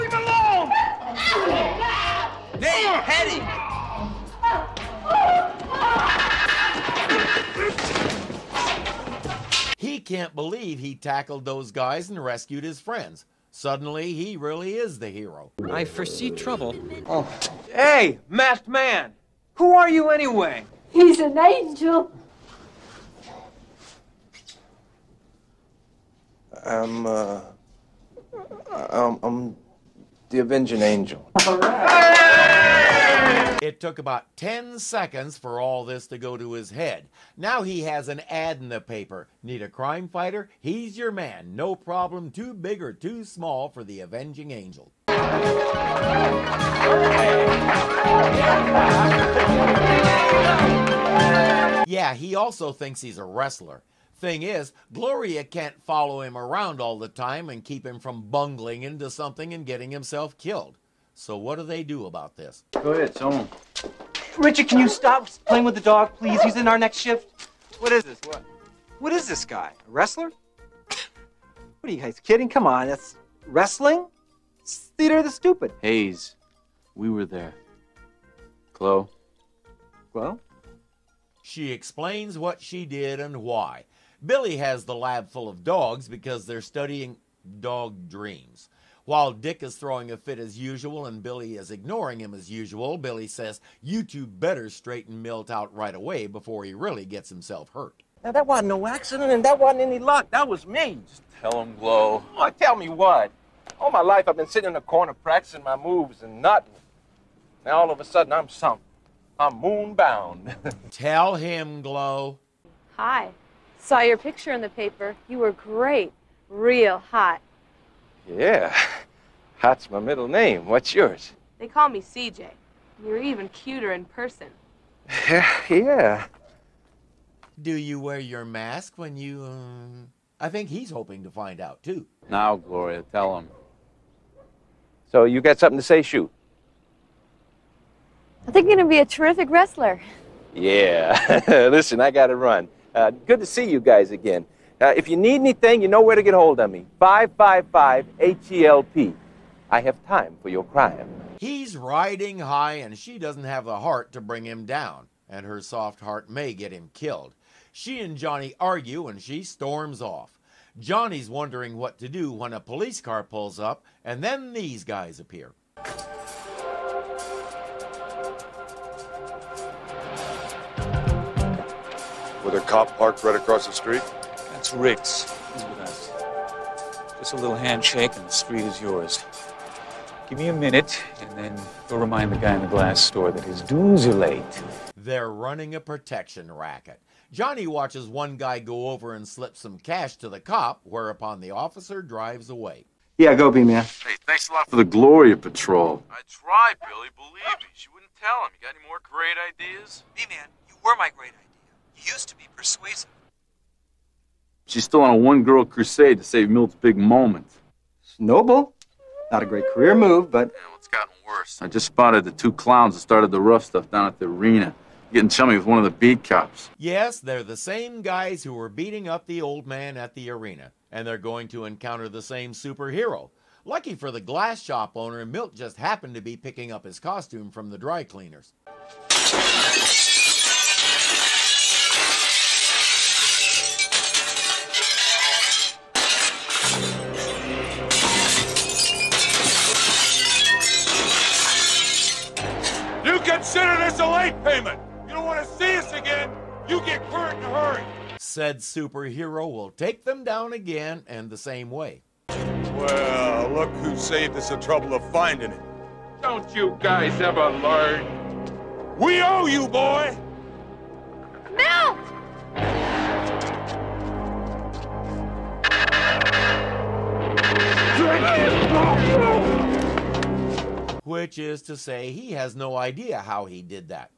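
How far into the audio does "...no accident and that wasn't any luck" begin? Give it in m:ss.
1:38.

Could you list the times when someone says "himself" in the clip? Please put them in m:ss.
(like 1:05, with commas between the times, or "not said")
0:59, 1:37.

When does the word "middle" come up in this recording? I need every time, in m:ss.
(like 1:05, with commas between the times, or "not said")
1:59.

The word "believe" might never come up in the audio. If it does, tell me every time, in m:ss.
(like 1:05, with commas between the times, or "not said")
0:10, 3:17.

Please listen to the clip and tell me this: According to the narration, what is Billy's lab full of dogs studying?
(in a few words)
dog dreams.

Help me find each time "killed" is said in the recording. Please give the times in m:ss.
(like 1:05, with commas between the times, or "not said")
1:00, 2:36.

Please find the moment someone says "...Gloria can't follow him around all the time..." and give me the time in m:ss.
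0:54.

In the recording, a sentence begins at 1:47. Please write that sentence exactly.
Now all of a sudden I'm something.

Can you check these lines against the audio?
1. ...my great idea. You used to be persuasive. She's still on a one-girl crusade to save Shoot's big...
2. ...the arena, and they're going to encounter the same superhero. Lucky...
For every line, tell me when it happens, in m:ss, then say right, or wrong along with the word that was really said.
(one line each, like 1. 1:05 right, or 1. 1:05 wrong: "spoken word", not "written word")
1. 3:20 wrong: "Milt", not "Shoot"
2. 3:40 right.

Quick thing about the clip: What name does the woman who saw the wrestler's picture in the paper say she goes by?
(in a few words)
CJ.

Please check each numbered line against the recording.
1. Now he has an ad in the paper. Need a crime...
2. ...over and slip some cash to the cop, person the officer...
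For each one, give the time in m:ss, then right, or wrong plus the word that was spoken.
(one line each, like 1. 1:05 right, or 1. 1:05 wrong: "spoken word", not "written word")
1. 0:37 right
2. 3:08 wrong: "whereupon", not "person".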